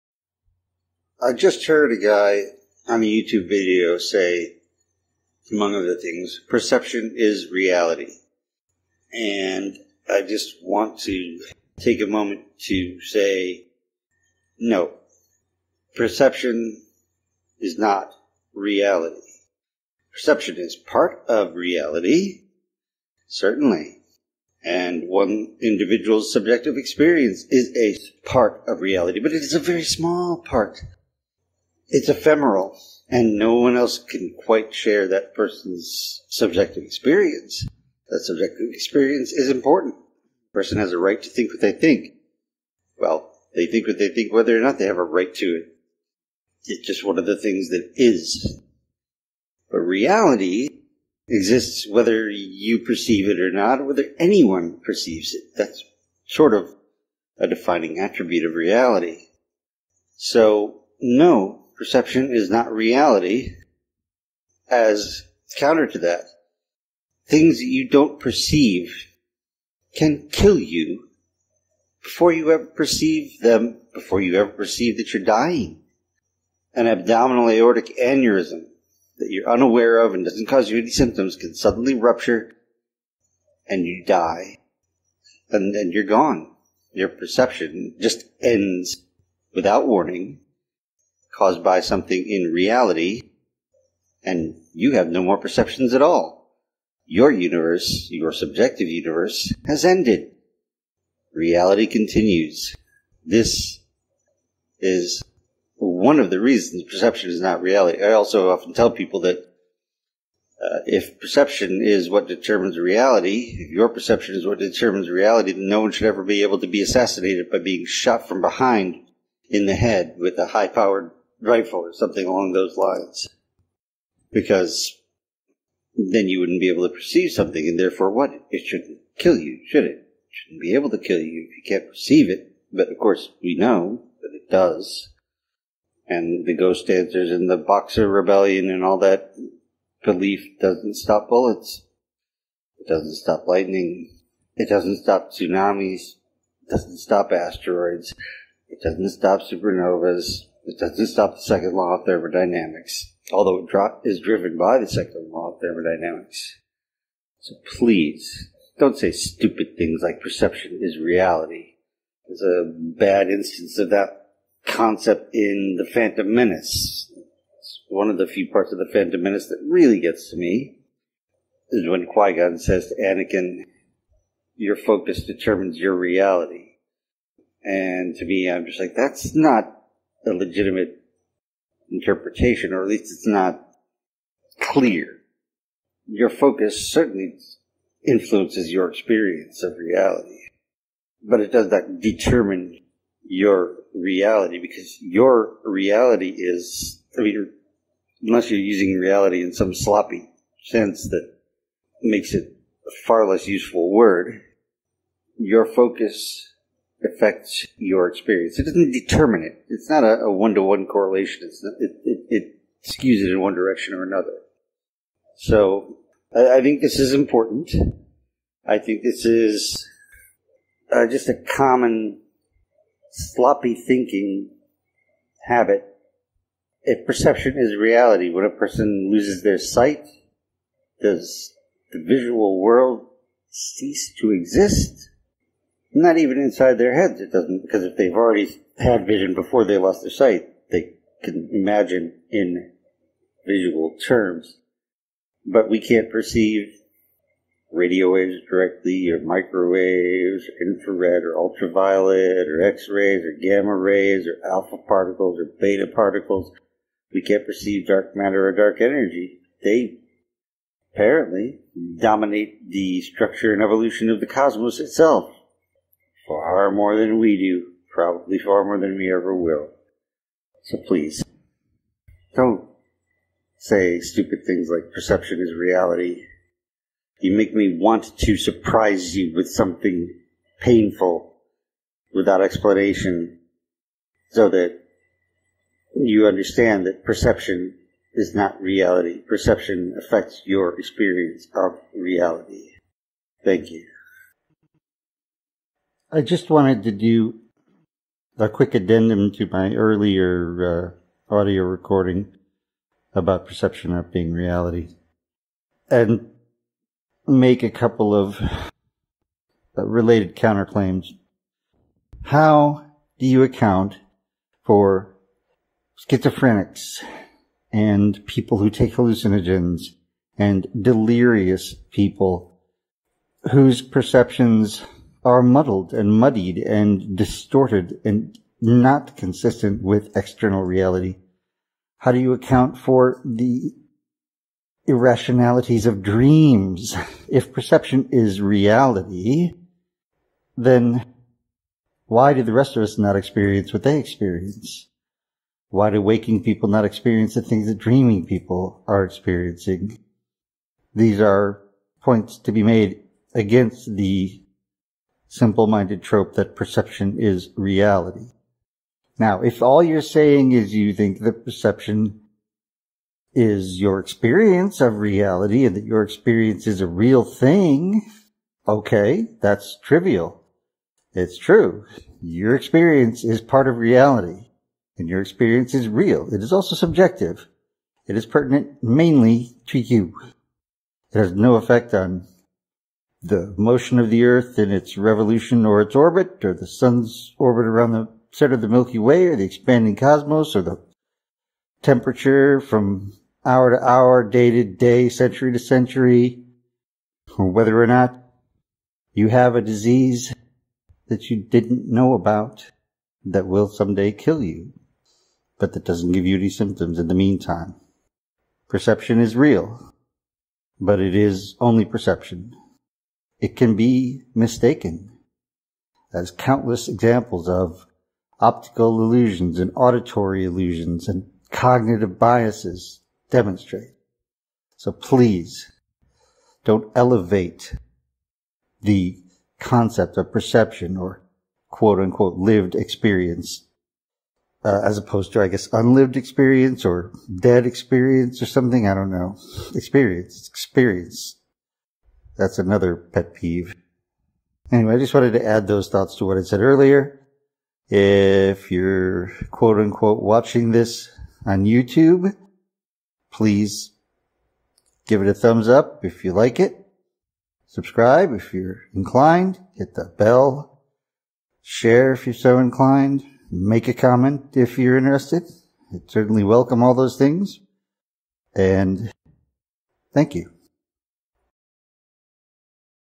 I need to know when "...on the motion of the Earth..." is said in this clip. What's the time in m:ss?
6:21.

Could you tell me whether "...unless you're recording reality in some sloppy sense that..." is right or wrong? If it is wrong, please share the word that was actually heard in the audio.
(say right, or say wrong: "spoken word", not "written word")
wrong: "using", not "recording".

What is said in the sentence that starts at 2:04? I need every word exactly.
Because then you wouldn't be able to perceive something, and therefore what?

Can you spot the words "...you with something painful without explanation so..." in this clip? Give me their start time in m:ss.
4:39.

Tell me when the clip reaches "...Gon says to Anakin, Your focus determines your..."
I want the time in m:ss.
2:52.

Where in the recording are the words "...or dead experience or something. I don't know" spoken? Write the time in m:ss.
7:16.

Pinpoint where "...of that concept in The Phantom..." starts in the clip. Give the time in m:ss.
2:43.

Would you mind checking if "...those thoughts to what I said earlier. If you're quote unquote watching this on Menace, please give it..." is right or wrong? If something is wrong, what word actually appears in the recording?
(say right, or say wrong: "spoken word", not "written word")
wrong: "YouTube", not "Menace".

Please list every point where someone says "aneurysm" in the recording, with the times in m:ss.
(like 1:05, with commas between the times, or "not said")
1:17.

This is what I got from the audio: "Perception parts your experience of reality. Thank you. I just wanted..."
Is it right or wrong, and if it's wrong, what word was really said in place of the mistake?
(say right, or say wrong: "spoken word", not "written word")
wrong: "affects", not "parts".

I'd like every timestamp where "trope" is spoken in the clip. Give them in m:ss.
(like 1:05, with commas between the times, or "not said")
5:56.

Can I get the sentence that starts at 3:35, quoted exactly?
So I, I think this is important.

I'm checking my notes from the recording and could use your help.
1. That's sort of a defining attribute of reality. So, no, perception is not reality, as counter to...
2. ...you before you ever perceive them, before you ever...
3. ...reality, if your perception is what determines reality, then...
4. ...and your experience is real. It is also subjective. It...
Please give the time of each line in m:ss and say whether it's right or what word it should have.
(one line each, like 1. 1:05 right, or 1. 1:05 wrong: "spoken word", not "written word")
1. 0:55 right
2. 1:10 right
3. 1:52 right
4. 6:14 right.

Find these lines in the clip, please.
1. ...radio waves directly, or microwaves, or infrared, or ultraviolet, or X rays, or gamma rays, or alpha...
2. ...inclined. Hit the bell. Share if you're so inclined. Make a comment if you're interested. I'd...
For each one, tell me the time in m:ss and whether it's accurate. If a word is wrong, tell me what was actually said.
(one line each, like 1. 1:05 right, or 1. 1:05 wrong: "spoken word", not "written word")
1. 4:07 right
2. 7:38 right.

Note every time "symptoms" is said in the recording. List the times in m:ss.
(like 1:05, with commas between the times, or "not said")
1:20, 6:46.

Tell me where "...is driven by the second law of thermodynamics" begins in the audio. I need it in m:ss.
2:34.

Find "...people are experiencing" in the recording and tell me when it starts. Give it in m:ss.
5:48.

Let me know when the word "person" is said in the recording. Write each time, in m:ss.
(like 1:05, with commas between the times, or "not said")
0:35, 0:40, 3:48.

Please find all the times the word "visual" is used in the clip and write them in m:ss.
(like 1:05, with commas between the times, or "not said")
3:52, 4:03.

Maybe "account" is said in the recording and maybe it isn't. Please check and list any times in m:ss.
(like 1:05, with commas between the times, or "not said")
5:13, 5:32.